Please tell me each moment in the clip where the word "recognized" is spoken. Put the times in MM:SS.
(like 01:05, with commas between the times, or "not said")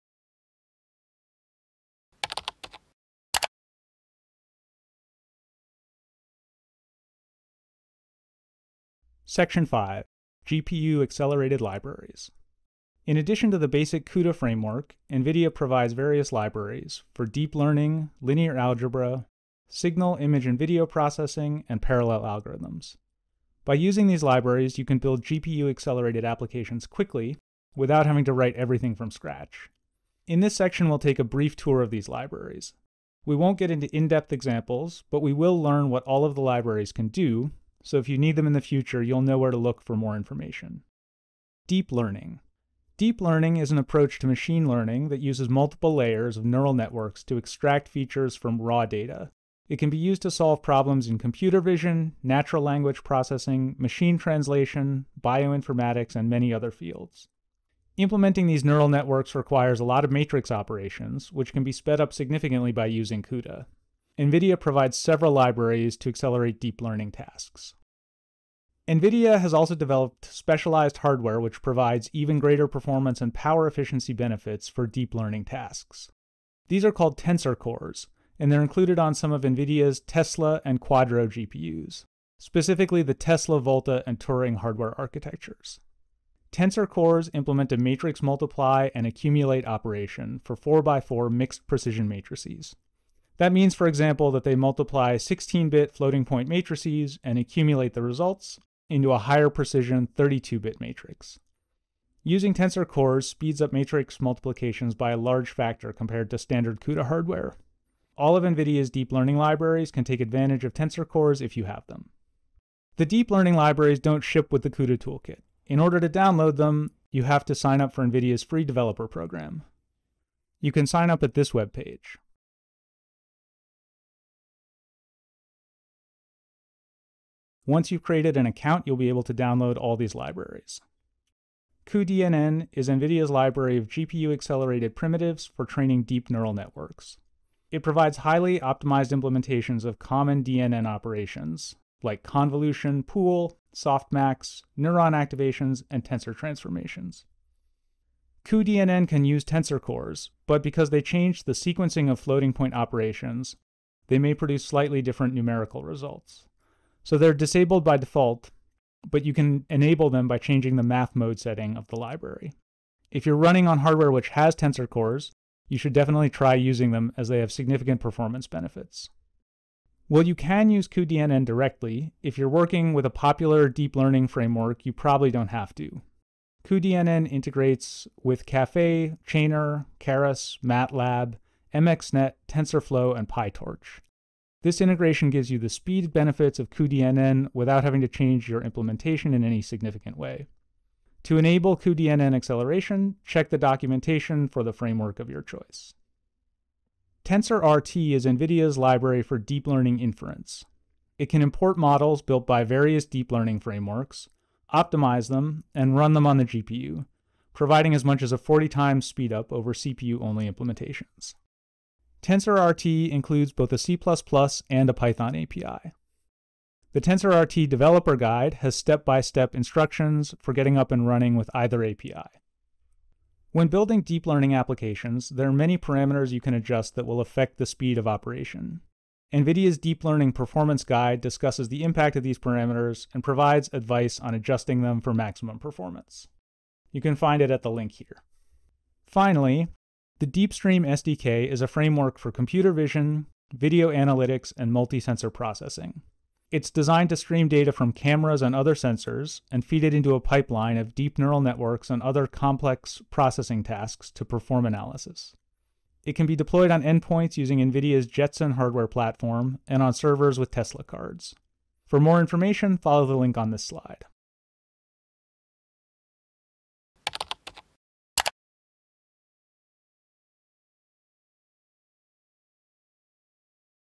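not said.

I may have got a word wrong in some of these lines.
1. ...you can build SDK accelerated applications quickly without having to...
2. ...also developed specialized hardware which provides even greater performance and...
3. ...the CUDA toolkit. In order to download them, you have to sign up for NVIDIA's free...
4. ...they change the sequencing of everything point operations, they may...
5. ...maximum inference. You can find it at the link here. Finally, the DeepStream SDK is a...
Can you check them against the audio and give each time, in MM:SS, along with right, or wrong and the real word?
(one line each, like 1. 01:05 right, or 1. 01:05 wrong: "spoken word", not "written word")
1. 00:24 wrong: "GPU", not "SDK"
2. 01:09 right
3. 01:54 right
4. 02:30 wrong: "floating", not "everything"
5. 03:55 wrong: "performance", not "inference".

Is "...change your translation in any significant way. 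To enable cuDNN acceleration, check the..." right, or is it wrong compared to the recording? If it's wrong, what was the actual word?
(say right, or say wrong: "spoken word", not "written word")
wrong: "implementation", not "translation".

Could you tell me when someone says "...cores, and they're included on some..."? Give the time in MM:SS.
01:17.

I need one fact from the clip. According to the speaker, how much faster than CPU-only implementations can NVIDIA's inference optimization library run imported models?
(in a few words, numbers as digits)
40 times.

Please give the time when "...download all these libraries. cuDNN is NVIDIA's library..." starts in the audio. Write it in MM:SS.
02:09.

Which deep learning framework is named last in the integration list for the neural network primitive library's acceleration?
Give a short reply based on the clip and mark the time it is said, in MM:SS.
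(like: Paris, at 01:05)
PyTorch, at 03:03.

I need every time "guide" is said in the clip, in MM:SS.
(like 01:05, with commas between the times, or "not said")
03:38, 03:50.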